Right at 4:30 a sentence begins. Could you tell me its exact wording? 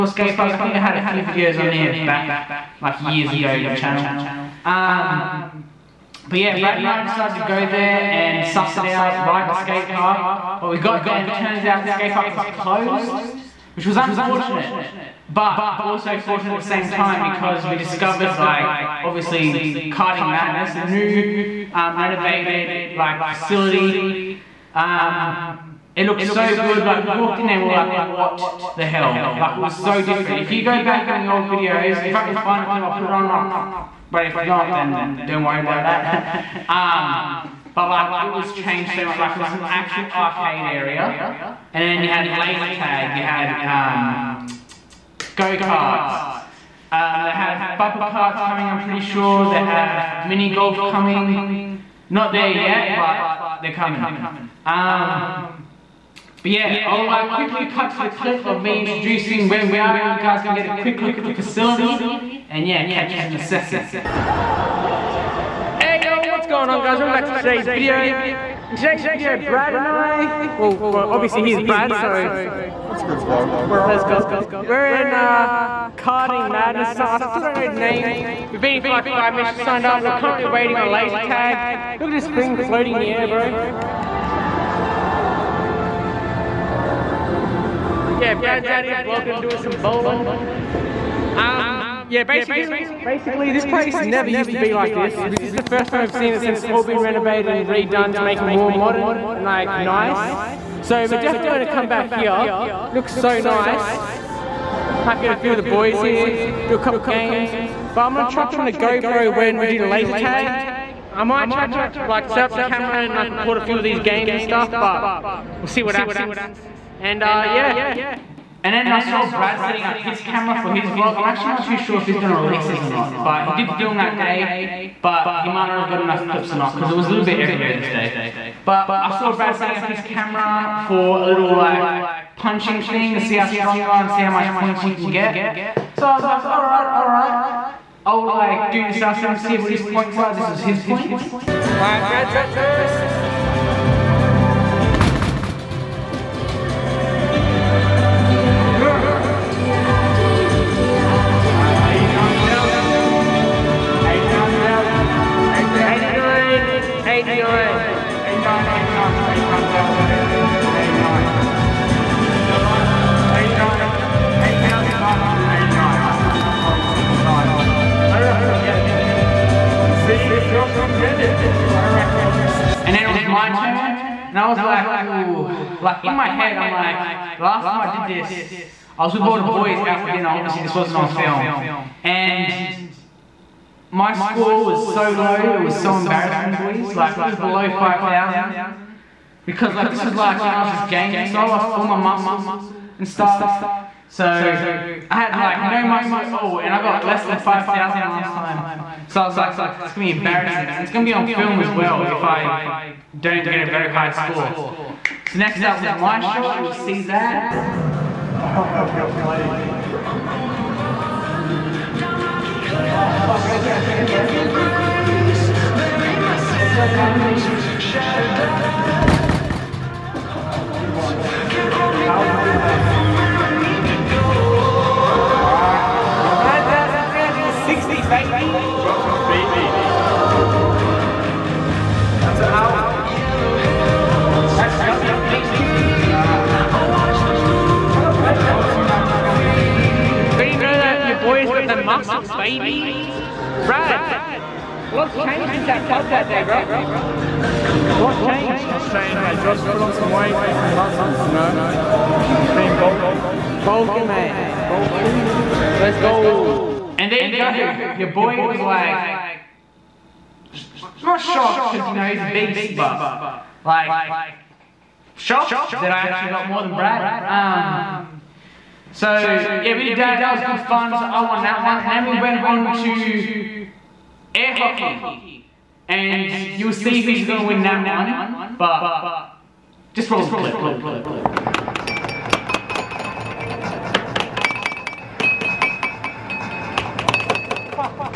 So I won that one, and then we went on to air hockey, and you'll see who's gonna win that one.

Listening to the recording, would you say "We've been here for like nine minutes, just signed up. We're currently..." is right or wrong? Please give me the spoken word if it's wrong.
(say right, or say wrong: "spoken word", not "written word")
wrong: "five", not "nine".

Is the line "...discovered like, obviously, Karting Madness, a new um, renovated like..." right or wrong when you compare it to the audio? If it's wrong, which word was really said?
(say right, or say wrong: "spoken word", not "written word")
right.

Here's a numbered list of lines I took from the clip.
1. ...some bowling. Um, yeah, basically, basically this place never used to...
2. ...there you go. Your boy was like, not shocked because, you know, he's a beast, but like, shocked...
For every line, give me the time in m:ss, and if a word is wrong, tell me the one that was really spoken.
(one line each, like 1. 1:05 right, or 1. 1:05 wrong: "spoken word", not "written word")
1. 1:29 right
2. 4:17 right.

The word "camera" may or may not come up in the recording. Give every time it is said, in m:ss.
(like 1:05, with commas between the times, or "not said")
1:52, 2:00, 2:10.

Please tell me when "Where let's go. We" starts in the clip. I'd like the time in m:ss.
1:13.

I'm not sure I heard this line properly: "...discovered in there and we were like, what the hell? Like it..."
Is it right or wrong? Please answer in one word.
wrong.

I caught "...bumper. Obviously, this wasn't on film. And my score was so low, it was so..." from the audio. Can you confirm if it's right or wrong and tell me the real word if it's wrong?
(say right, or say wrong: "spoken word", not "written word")
wrong: "dinner", not "bumper".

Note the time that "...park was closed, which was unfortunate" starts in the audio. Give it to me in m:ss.
0:12.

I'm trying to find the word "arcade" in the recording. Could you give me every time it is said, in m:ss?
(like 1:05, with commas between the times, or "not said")
0:40.